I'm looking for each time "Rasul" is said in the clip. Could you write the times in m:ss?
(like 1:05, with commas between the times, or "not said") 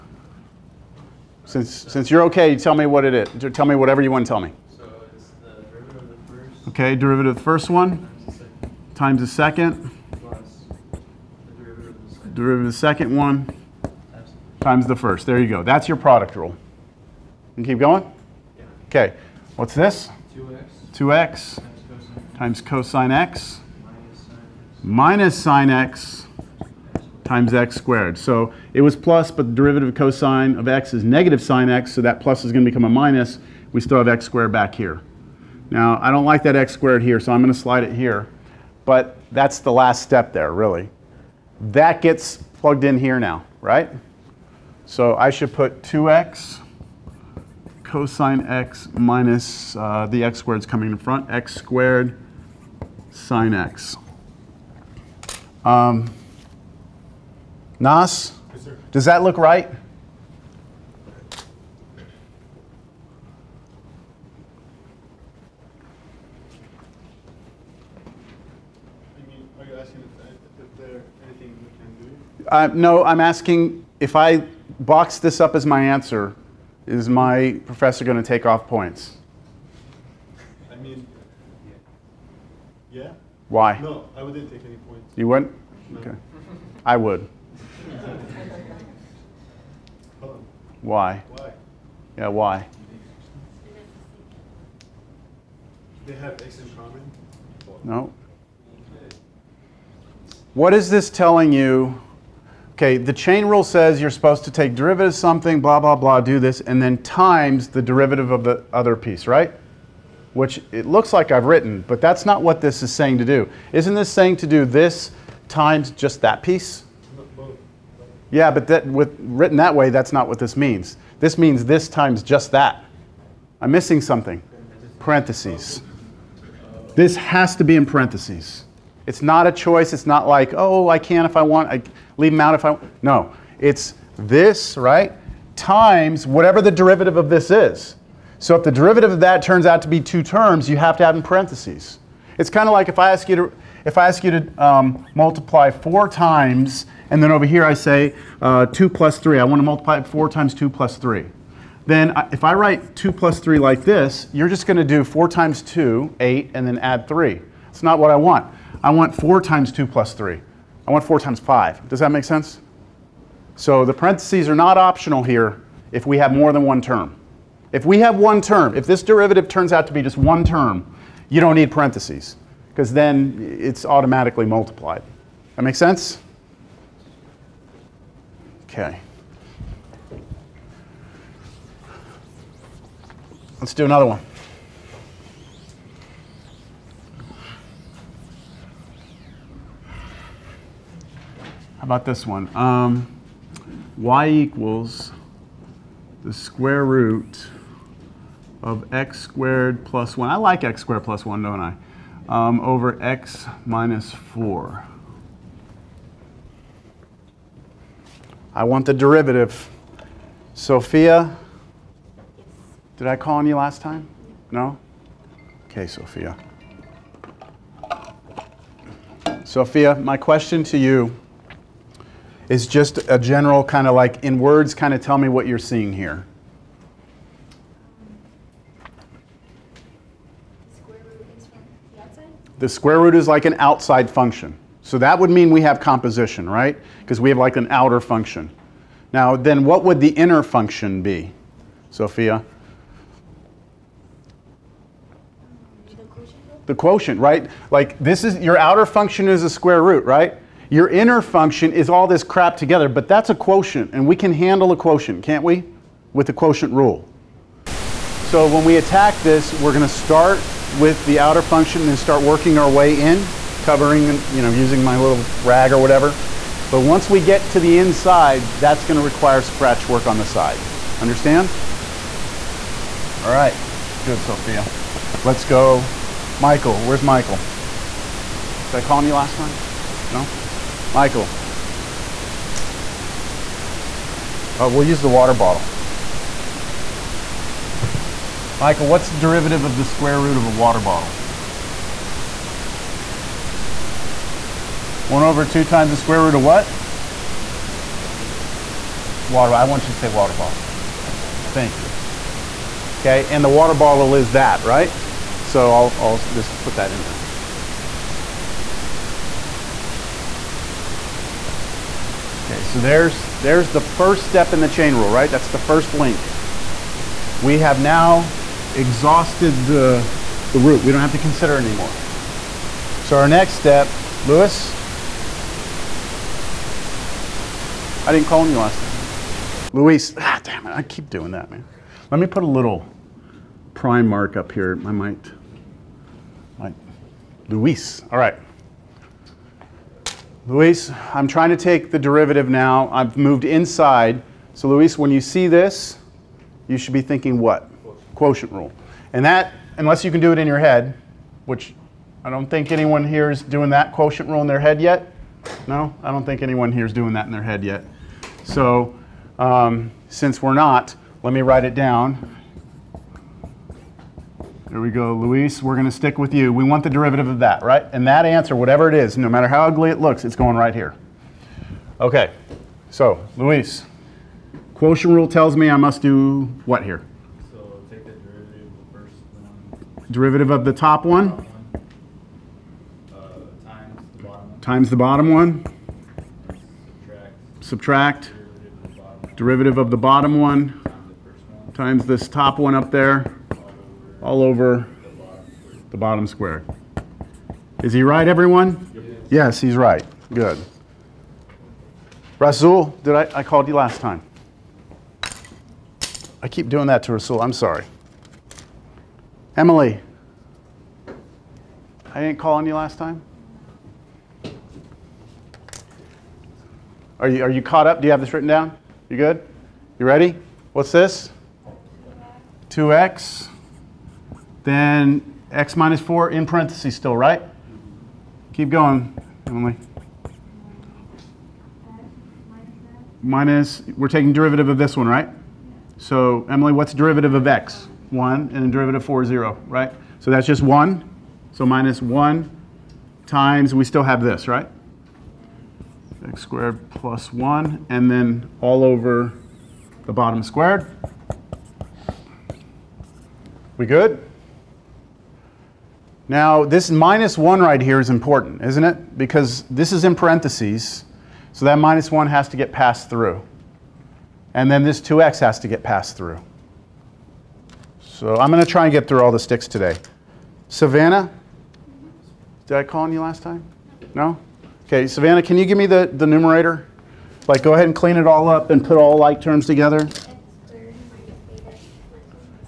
6:42, 6:47.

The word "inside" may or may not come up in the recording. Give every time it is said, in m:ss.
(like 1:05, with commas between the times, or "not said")
4:27, 5:43.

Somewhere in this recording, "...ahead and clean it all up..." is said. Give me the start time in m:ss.
7:57.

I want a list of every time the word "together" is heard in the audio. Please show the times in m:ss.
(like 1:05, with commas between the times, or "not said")
4:12, 7:59.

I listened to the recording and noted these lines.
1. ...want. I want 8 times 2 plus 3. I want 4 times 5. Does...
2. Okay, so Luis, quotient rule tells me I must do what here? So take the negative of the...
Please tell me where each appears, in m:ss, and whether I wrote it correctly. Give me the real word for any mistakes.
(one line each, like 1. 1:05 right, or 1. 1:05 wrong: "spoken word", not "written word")
1. 2:38 wrong: "4", not "8"
2. 6:11 wrong: "derivative", not "negative".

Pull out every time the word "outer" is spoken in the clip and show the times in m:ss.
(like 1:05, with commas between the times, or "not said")
3:57, 4:08, 4:21.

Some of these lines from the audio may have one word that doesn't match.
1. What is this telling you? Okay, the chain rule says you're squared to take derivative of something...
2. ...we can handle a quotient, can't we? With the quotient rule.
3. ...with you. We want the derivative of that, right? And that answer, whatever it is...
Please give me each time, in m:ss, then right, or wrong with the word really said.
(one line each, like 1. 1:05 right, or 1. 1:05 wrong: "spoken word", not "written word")
1. 1:40 wrong: "supposed", not "squared"
2. 4:14 right
3. 6:06 right.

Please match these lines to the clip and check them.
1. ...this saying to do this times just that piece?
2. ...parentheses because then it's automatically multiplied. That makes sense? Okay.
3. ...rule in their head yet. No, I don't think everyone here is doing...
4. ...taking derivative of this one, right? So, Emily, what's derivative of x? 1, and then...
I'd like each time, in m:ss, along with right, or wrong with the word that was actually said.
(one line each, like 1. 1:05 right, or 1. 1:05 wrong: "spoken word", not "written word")
1. 1:53 right
2. 2:51 right
3. 5:54 wrong: "anyone", not "everyone"
4. 7:14 right.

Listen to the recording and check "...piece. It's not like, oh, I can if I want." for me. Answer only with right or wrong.
wrong.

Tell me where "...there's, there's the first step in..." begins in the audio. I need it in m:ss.
5:12.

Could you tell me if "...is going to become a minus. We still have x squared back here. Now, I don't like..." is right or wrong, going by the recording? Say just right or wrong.
right.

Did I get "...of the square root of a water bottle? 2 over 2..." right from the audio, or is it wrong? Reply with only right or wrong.
wrong.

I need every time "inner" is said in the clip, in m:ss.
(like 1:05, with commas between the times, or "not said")
4:00, 4:10.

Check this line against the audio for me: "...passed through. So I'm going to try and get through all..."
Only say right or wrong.
right.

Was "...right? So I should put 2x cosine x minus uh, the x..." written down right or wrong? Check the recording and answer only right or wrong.
right.